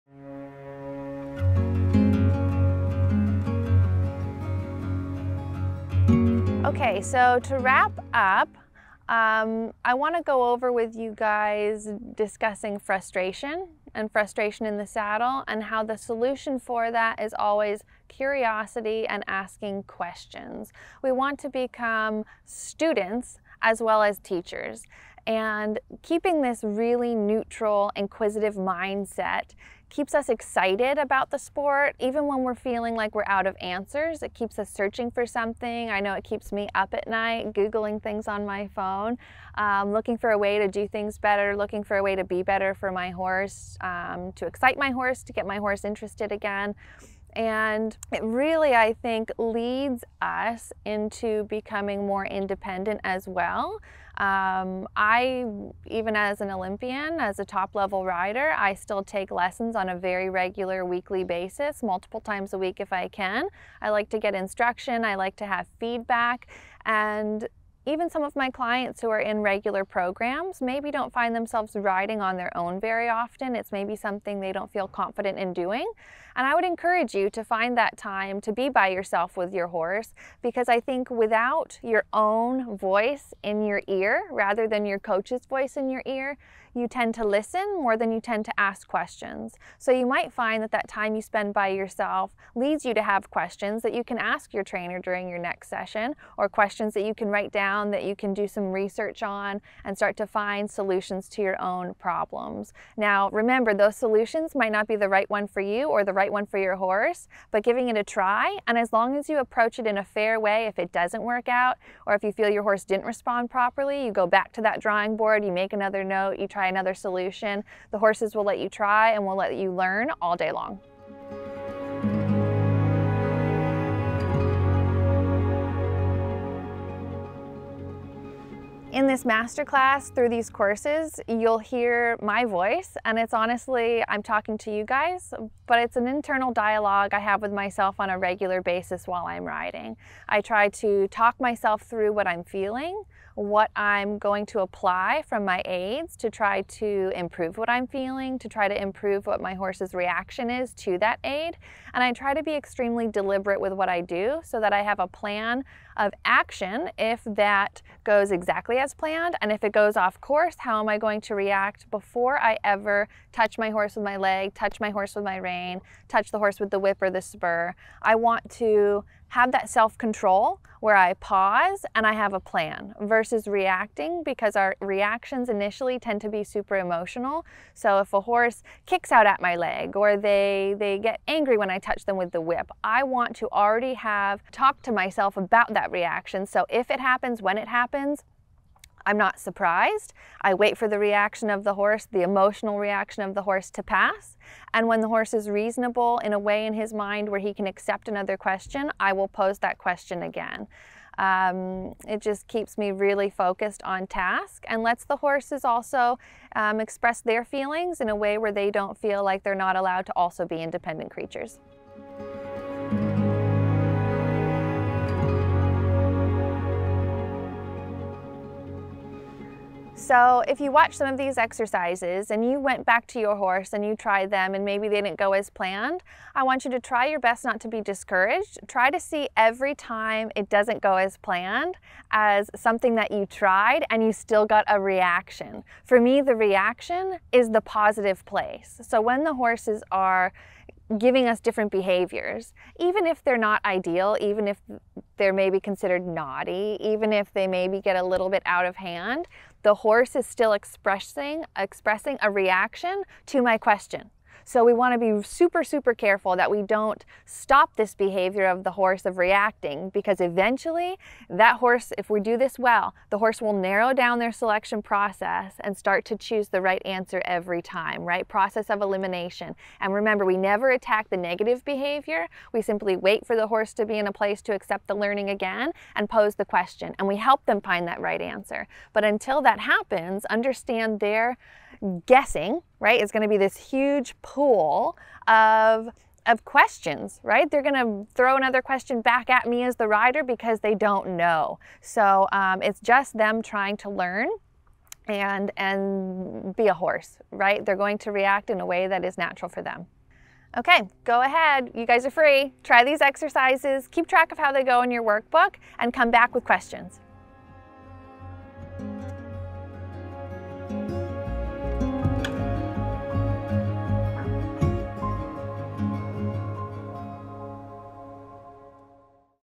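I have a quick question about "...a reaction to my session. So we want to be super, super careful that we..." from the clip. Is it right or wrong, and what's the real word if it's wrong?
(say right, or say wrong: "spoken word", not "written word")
wrong: "question", not "session".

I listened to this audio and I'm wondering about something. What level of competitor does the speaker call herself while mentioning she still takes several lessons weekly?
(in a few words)
Olympian.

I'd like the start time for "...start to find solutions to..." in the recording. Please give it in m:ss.
1:39.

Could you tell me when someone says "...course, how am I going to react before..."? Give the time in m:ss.
2:40.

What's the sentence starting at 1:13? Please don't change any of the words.
It's maybe something they don't feel confident in doing.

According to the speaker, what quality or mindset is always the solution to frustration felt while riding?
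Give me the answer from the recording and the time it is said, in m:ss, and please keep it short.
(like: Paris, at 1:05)
Curiosity, at 0:18.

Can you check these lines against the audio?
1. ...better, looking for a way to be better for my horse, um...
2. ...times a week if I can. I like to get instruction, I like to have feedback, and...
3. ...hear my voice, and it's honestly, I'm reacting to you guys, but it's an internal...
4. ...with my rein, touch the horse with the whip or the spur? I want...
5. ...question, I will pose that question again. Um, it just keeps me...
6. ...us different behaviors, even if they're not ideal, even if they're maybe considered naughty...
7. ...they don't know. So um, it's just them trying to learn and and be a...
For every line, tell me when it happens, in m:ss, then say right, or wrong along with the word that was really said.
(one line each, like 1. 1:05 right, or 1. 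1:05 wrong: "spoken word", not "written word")
1. 0:41 right
2. 1:02 right
3. 2:11 wrong: "talking", not "reacting"
4. 2:45 right
5. 3:18 right
6. 4:01 right
7. 4:50 right.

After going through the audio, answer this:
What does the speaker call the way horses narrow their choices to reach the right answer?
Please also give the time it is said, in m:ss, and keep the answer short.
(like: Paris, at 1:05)
Process of elimination, at 4:28.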